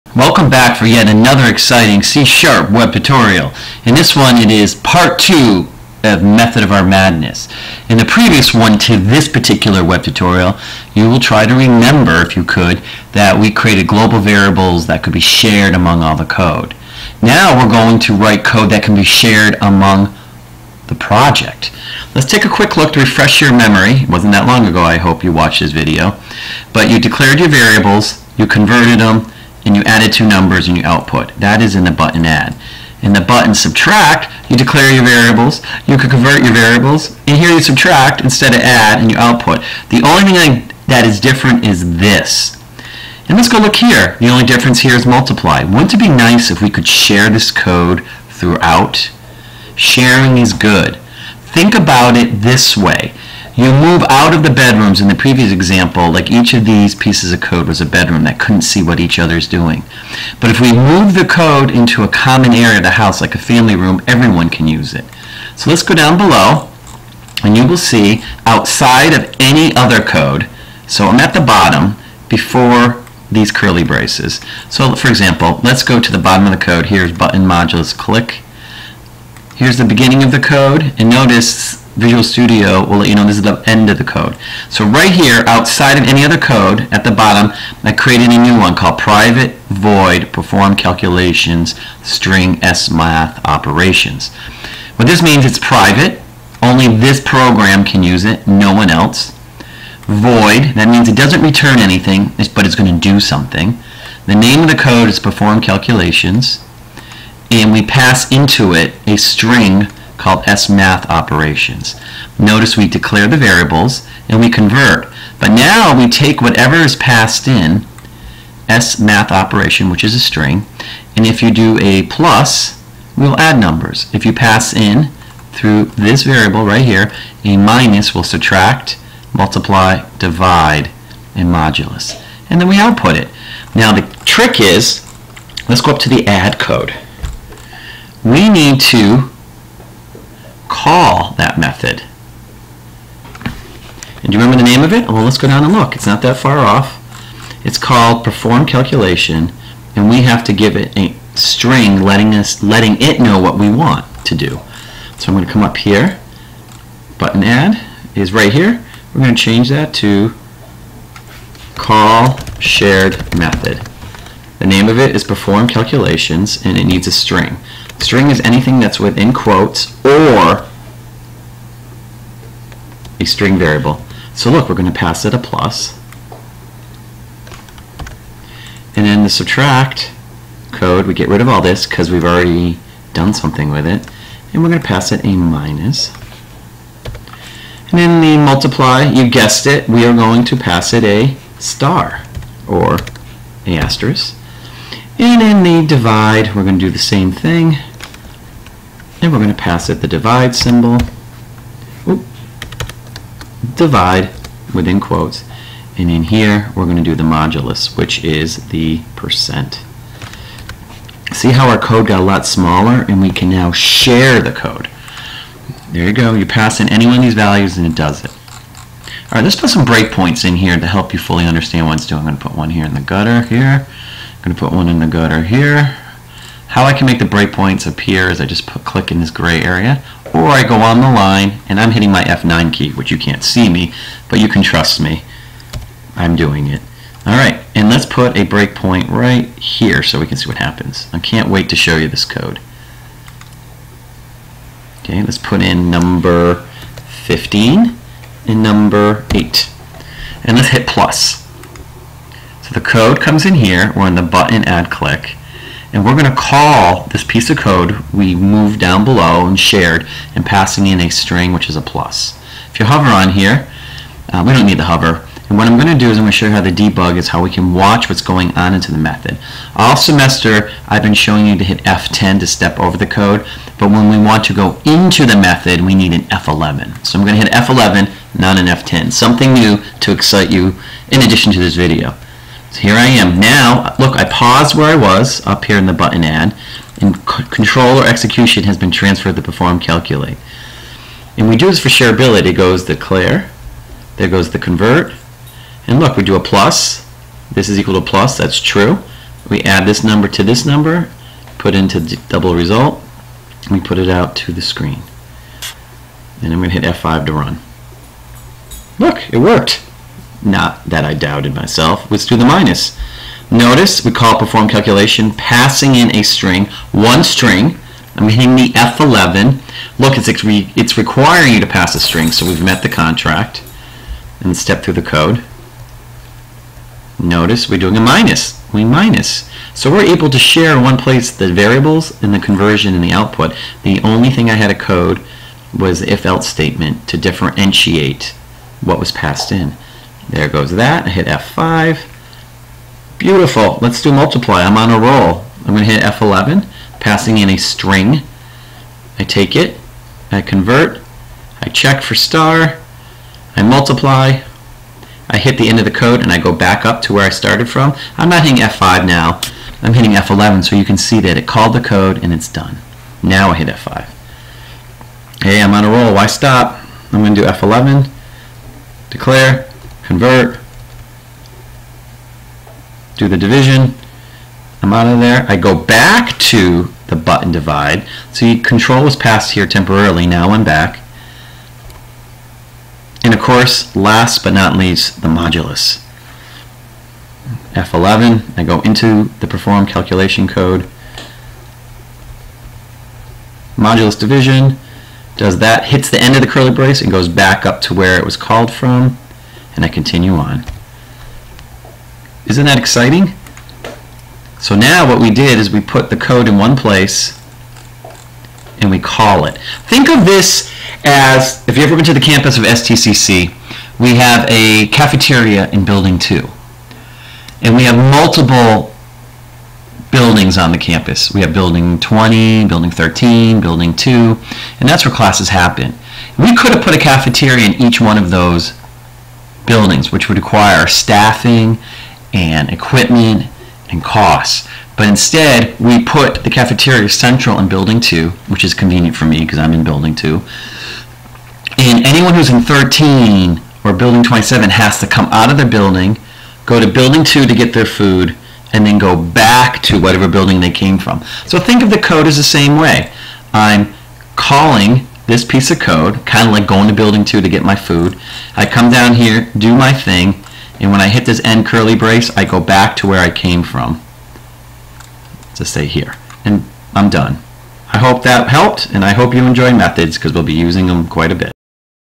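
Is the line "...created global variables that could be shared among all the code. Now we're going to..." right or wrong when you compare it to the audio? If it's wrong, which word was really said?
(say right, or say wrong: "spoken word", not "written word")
right.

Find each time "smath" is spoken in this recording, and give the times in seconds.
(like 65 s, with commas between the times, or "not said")
92 s, 110 s, 118 s.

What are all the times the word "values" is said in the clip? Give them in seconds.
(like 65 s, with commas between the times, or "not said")
217 s.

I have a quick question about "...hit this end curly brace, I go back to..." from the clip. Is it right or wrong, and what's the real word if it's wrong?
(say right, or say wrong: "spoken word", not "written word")
right.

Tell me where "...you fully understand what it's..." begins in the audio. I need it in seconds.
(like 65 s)
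221 s.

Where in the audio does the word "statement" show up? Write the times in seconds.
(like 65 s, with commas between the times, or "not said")
336 s.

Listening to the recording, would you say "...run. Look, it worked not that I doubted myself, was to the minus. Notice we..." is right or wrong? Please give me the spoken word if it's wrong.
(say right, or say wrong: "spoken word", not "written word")
right.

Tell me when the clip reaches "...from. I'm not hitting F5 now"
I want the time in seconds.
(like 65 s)
357 s.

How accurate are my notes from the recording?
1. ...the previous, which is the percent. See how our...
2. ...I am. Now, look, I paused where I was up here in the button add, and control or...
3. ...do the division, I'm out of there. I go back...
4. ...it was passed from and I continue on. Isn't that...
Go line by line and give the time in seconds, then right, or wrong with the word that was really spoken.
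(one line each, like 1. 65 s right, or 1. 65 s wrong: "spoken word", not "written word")
1. 207 s wrong: "modulus", not "previous"
2. 282 s right
3. 373 s right
4. 398 s wrong: "called", not "passed".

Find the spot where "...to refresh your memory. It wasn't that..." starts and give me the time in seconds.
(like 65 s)
22 s.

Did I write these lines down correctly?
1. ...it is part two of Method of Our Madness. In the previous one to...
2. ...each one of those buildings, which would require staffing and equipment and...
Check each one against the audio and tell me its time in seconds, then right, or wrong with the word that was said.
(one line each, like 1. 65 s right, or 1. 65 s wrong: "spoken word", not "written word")
1. 4 s right
2. 427 s right.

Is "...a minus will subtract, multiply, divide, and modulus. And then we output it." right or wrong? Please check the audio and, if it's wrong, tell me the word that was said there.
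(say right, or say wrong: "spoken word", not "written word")
right.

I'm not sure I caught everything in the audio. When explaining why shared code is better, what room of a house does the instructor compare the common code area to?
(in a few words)
Family room.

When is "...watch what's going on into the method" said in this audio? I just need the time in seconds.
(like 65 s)
267 s.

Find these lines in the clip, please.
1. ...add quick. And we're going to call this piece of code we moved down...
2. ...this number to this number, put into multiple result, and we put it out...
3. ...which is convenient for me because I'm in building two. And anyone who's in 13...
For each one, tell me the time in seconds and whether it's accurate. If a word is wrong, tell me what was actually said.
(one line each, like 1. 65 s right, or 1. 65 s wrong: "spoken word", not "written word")
1. 254 s wrong: "click", not "quick"
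2. 299 s wrong: "double", not "multiple"
3. 438 s right.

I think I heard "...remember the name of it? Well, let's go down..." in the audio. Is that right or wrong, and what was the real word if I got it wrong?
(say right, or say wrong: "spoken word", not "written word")
right.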